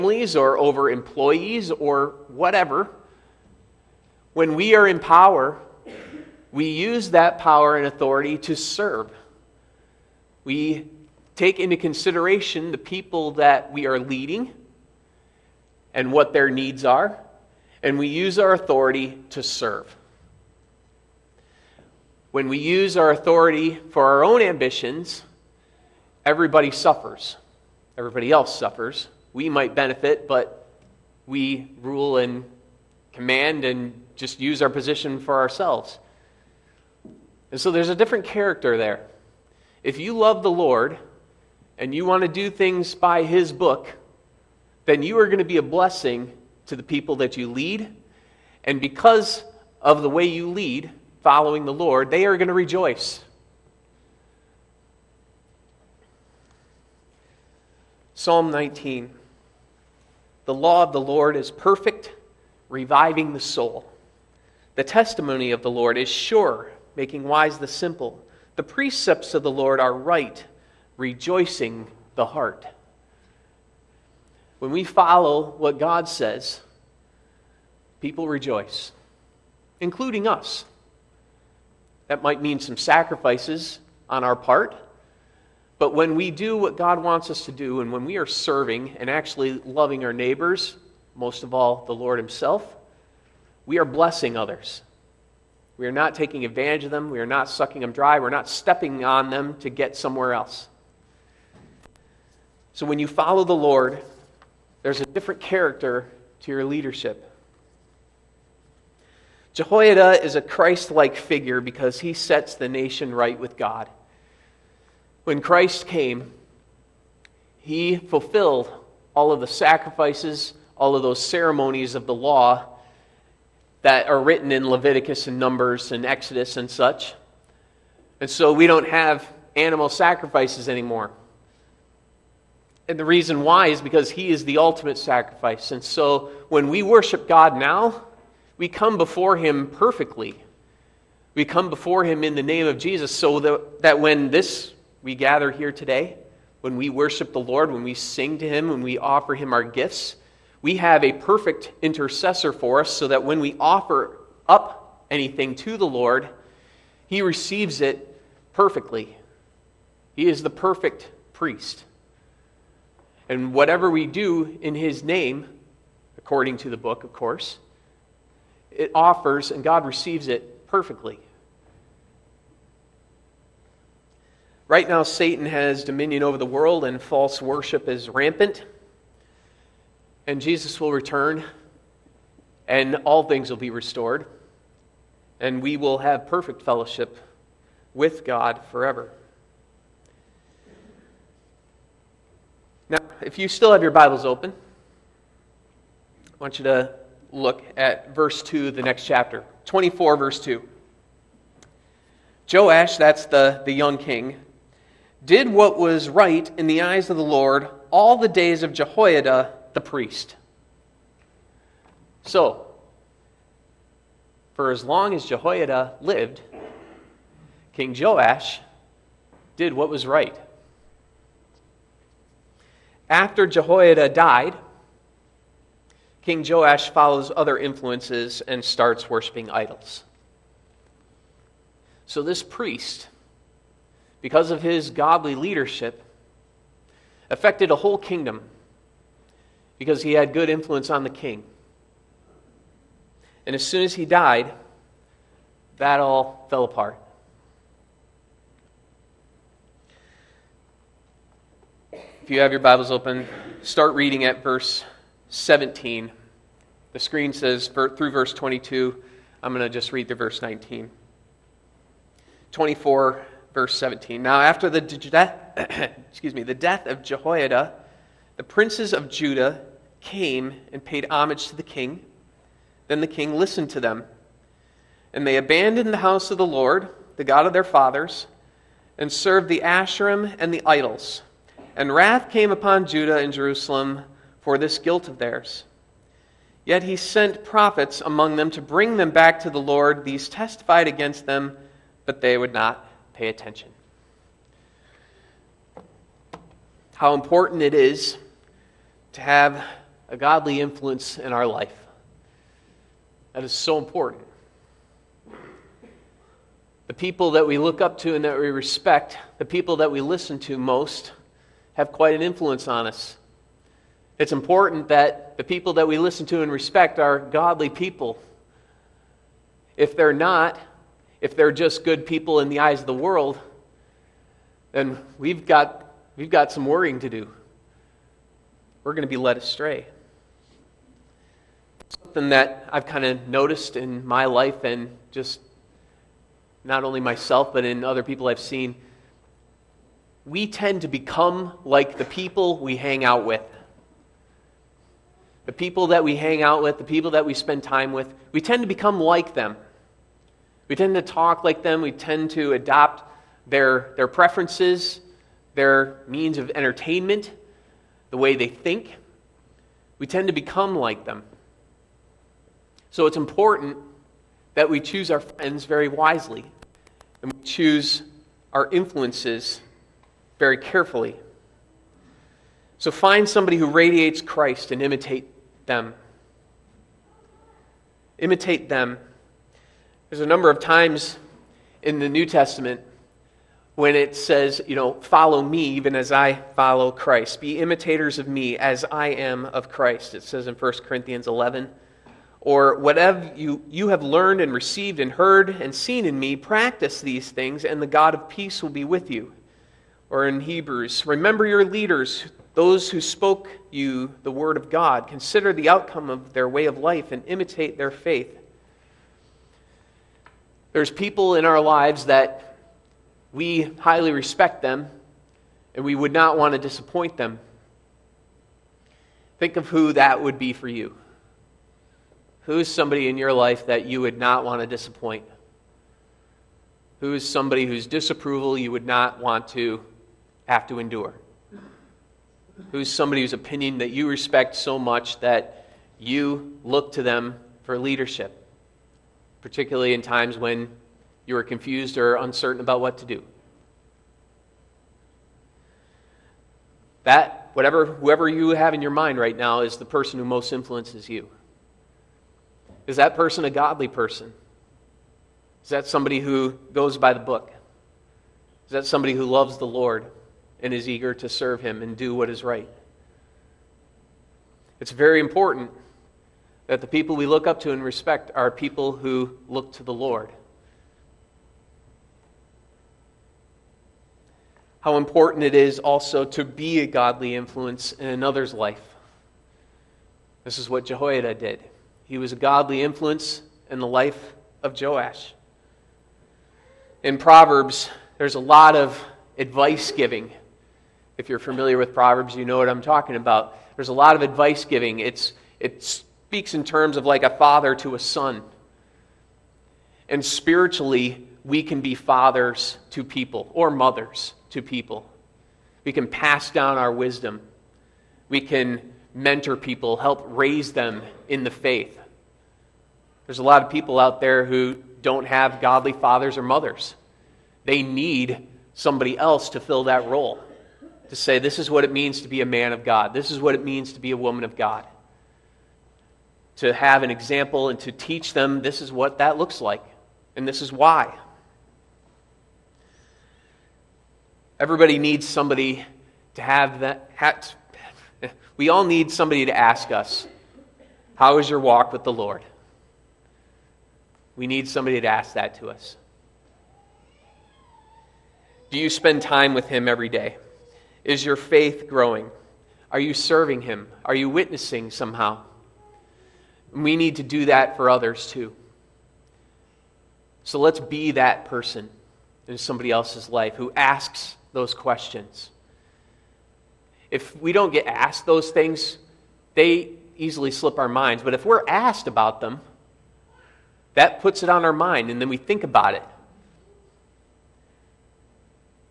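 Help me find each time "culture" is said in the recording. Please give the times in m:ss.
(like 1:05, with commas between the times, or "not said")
not said.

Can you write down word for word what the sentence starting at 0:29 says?
We might benefit, but we rule and command and just use our position for ourselves.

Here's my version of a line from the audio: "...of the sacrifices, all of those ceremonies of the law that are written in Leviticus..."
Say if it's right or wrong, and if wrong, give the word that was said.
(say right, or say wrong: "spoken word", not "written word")
right.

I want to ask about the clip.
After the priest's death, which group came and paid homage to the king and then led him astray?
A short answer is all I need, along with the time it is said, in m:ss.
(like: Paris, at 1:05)
the princes of Judah, at 4:28.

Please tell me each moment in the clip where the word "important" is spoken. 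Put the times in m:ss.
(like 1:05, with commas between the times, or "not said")
4:57, 5:03, 5:14, 6:03, 7:45, 7:54.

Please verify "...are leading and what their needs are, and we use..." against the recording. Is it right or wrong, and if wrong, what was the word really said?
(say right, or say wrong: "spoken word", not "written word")
right.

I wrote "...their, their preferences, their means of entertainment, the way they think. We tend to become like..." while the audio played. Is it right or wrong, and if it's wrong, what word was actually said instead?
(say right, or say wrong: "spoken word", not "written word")
right.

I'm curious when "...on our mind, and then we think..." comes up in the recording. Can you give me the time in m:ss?
9:34.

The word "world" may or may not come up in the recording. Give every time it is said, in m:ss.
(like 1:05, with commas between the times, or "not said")
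2:56, 5:22.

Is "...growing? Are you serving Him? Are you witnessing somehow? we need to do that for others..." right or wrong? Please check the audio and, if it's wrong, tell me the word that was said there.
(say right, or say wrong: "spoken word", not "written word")
right.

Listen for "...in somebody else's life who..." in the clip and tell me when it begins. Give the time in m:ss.
9:22.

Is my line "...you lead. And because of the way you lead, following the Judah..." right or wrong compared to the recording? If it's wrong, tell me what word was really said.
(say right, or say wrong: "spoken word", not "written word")
wrong: "Lord", not "Judah".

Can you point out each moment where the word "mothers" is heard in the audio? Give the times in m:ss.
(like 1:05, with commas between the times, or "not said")
8:23, 8:36.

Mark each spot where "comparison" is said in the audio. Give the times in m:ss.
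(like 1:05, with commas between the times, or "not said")
not said.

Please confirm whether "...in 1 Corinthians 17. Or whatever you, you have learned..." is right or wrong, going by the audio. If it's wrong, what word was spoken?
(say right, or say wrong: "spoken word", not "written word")
wrong: "11", not "17".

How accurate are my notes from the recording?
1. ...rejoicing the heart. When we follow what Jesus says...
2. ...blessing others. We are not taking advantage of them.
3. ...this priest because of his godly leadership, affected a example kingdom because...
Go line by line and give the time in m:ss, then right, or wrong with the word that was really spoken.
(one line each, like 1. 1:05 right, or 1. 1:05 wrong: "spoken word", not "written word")
1. 1:10 wrong: "God", not "Jesus"
2. 1:33 right
3. 3:52 wrong: "whole", not "example".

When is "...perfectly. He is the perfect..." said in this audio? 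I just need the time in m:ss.
2:38.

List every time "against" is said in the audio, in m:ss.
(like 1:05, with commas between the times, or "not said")
4:50.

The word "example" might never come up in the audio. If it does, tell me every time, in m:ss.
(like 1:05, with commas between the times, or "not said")
8:47.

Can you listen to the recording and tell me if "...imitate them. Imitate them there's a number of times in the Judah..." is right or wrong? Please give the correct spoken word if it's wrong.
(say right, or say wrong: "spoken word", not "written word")
wrong: "New", not "Judah".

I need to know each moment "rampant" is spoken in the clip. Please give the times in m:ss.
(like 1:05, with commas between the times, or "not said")
2:58.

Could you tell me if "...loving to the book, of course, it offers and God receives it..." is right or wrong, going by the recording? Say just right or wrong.
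wrong.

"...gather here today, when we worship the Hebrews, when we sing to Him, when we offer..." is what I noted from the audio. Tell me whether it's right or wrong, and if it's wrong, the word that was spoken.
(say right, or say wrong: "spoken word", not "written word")
wrong: "Lord", not "Hebrews".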